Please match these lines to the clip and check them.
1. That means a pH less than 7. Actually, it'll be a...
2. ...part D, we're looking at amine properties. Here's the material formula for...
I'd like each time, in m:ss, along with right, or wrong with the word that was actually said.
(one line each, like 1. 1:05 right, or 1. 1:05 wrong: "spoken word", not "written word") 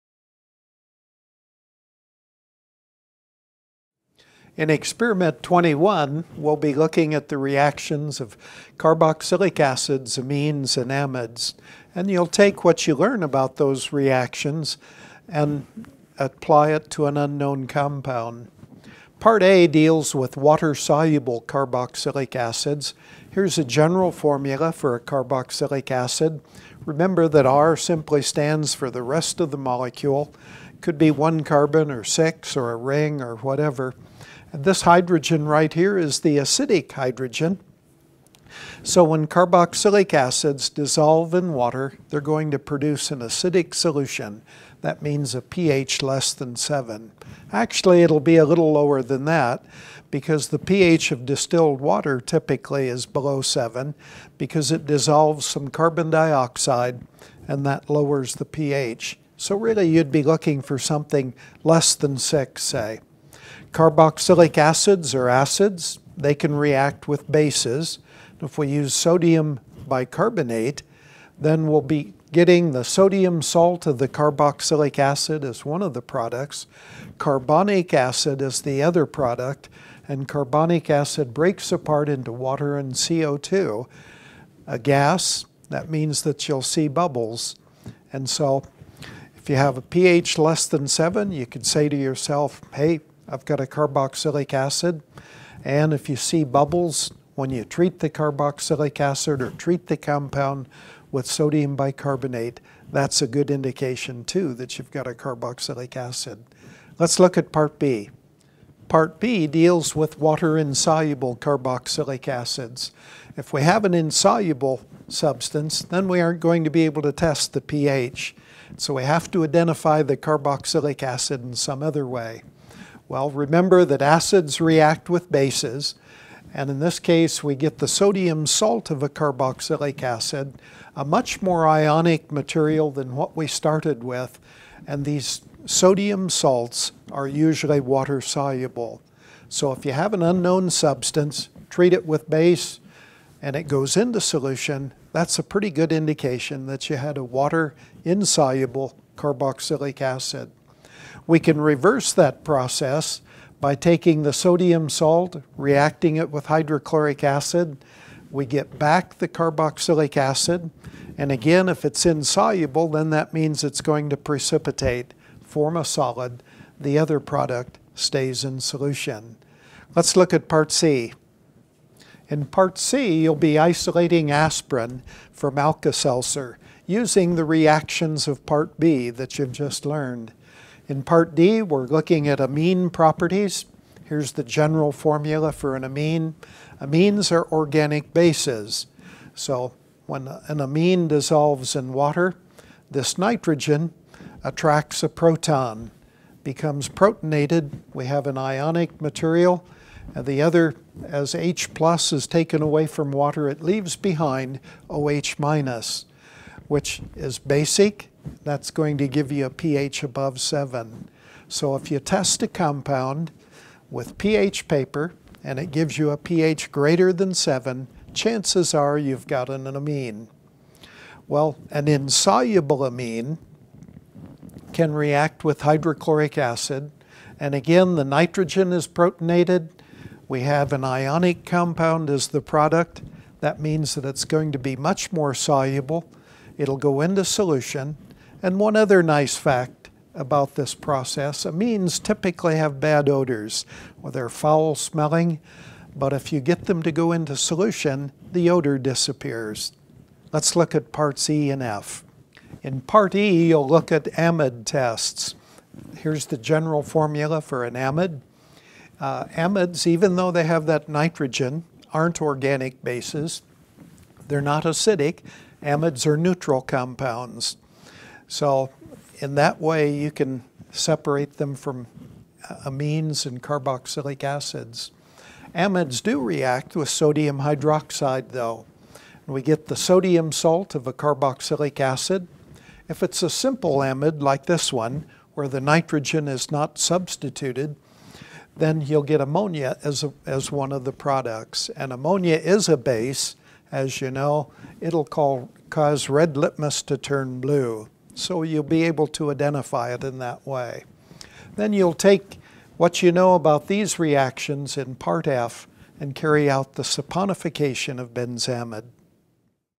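1. 0:44 right
2. 3:01 wrong: "general", not "material".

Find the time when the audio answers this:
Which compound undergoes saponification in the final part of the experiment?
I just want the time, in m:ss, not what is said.
5:08.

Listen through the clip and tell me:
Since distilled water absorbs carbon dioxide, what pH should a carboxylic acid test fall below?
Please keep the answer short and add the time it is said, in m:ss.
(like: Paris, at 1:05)
6, at 1:01.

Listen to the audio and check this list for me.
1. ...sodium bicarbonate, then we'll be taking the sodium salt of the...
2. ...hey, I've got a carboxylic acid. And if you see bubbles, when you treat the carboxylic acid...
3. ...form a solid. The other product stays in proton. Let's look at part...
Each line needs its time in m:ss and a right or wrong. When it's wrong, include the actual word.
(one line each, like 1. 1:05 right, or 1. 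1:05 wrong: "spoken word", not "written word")
1. 1:08 wrong: "getting", not "taking"
2. 1:32 right
3. 2:45 wrong: "solution", not "proton".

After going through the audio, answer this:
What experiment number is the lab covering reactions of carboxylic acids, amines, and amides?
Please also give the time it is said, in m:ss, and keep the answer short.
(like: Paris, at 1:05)
21, at 0:05.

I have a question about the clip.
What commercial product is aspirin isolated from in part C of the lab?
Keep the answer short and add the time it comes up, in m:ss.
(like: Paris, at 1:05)
Alka-Seltzer, at 2:55.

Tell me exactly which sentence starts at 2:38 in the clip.
We get back the carboxylic acid.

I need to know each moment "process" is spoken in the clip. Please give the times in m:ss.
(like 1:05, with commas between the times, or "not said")
2:32, 4:00.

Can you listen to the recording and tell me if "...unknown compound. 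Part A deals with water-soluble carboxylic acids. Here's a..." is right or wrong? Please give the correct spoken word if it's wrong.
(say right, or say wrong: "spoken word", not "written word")
right.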